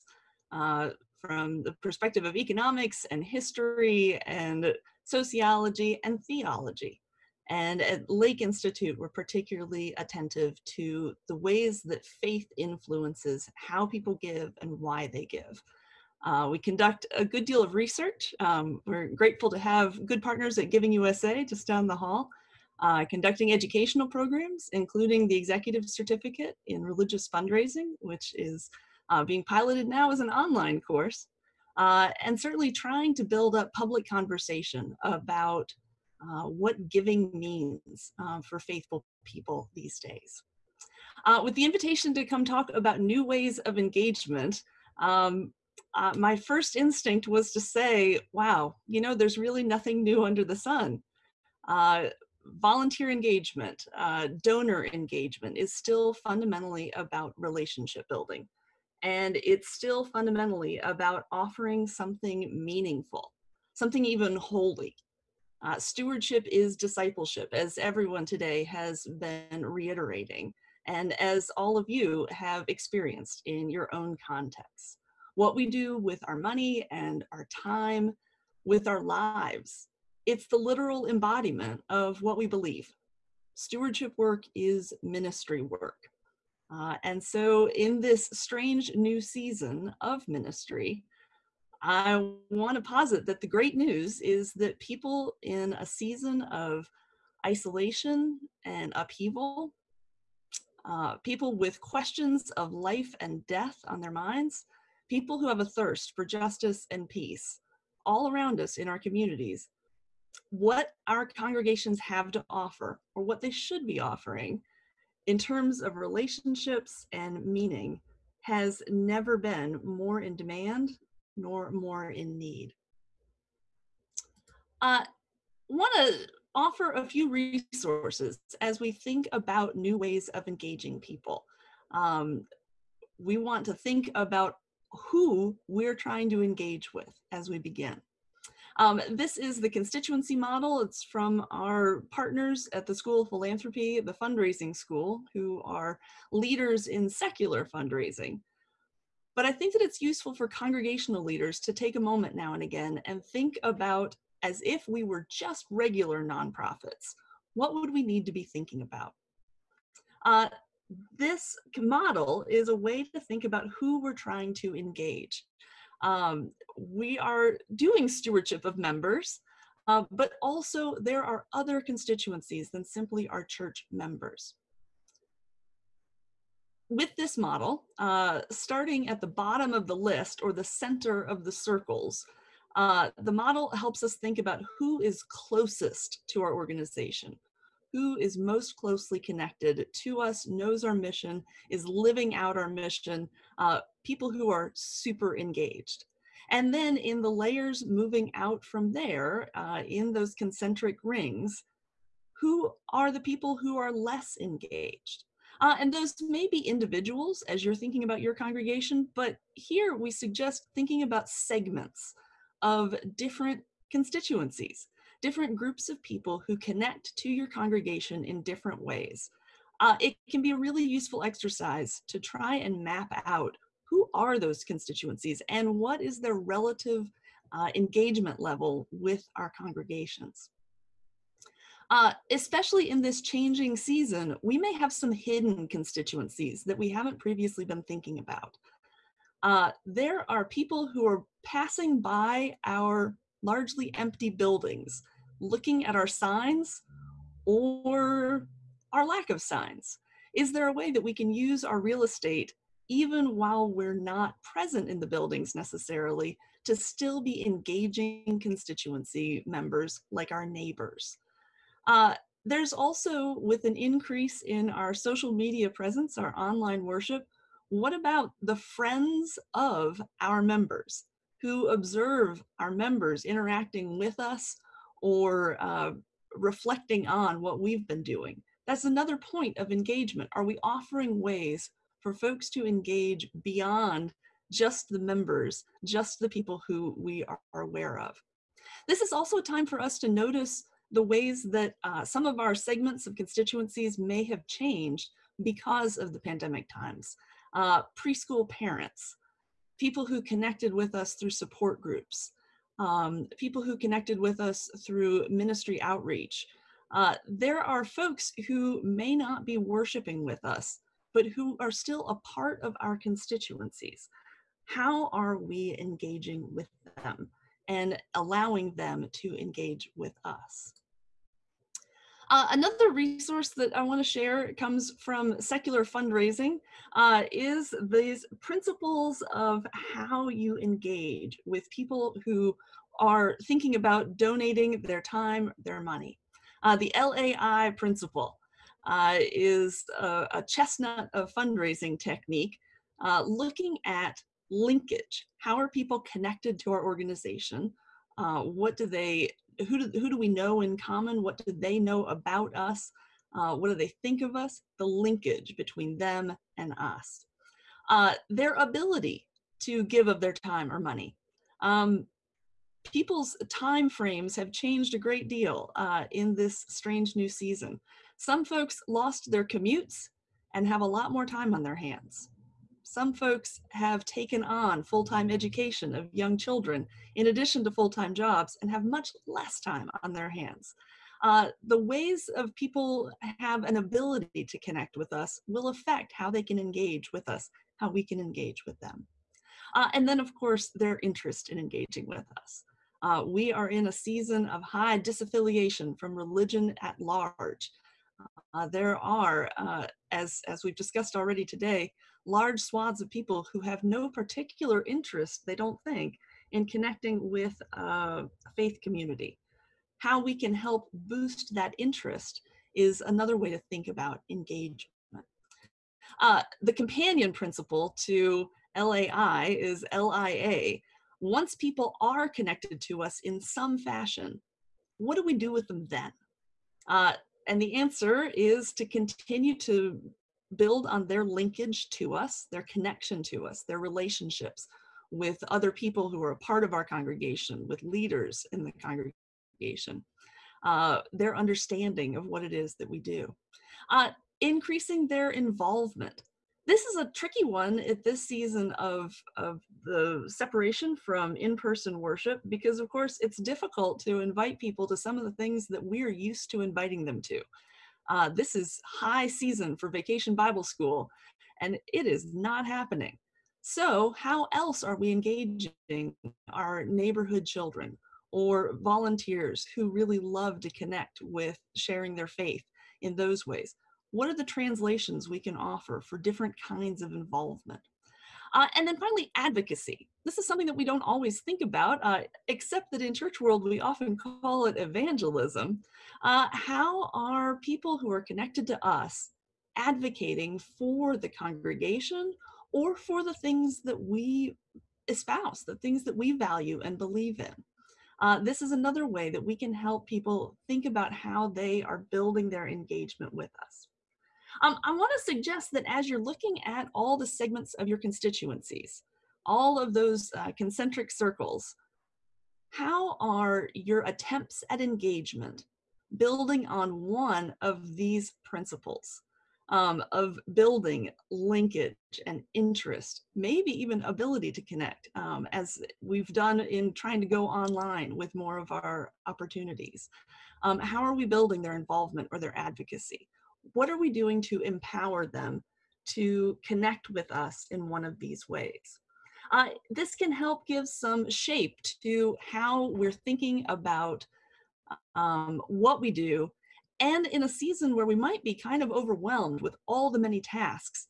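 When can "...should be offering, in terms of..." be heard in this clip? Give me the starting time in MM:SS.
01:53.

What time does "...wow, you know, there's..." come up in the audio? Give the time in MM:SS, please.
00:48.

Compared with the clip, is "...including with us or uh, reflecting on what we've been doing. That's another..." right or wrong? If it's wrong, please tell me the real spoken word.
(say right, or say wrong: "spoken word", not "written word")
wrong: "interacting", not "including".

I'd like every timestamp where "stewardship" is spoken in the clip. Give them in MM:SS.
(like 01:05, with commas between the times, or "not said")
01:05, 01:23, 02:48.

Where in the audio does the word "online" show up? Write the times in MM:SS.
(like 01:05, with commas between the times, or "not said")
00:30, 04:26, 08:47.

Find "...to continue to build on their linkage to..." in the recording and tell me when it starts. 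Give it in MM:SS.
07:08.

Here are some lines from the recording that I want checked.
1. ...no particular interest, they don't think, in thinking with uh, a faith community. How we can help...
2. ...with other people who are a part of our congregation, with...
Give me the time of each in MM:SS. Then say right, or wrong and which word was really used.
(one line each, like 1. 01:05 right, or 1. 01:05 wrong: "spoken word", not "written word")
1. 06:43 wrong: "connecting", not "thinking"
2. 07:15 right.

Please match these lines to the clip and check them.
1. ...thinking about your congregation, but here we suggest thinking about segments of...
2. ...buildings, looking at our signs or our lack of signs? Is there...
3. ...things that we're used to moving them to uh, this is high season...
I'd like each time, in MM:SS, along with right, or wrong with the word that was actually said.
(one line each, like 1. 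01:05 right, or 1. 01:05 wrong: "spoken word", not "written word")
1. 03:27 right
2. 04:04 right
3. 07:35 wrong: "inviting", not "moving".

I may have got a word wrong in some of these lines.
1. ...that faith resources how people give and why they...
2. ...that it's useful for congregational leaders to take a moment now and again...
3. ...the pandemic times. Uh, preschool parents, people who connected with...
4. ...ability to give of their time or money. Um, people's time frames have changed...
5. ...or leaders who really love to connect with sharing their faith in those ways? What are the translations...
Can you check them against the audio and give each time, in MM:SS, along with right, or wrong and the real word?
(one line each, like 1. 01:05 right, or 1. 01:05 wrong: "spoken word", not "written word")
1. 00:11 wrong: "influences", not "resources"
2. 02:29 right
3. 04:56 right
4. 05:58 right
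5. 07:48 wrong: "volunteers", not "leaders".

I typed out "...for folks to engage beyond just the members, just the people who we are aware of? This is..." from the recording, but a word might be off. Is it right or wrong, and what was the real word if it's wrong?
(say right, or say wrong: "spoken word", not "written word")
right.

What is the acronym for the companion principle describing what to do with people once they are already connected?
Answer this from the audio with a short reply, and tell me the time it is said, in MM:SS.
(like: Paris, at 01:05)
LIA, at 06:59.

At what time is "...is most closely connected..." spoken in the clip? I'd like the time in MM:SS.
03:08.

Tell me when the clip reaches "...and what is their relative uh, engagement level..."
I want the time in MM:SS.
03:45.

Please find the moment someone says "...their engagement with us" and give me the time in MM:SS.
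08:22.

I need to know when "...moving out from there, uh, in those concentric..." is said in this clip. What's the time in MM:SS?
03:17.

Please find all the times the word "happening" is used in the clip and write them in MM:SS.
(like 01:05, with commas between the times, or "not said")
07:42.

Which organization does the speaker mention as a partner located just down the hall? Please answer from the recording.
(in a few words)
Giving USA.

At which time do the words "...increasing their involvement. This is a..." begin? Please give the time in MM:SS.
07:24.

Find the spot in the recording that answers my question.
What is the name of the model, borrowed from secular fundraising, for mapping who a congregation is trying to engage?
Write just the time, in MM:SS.
02:19.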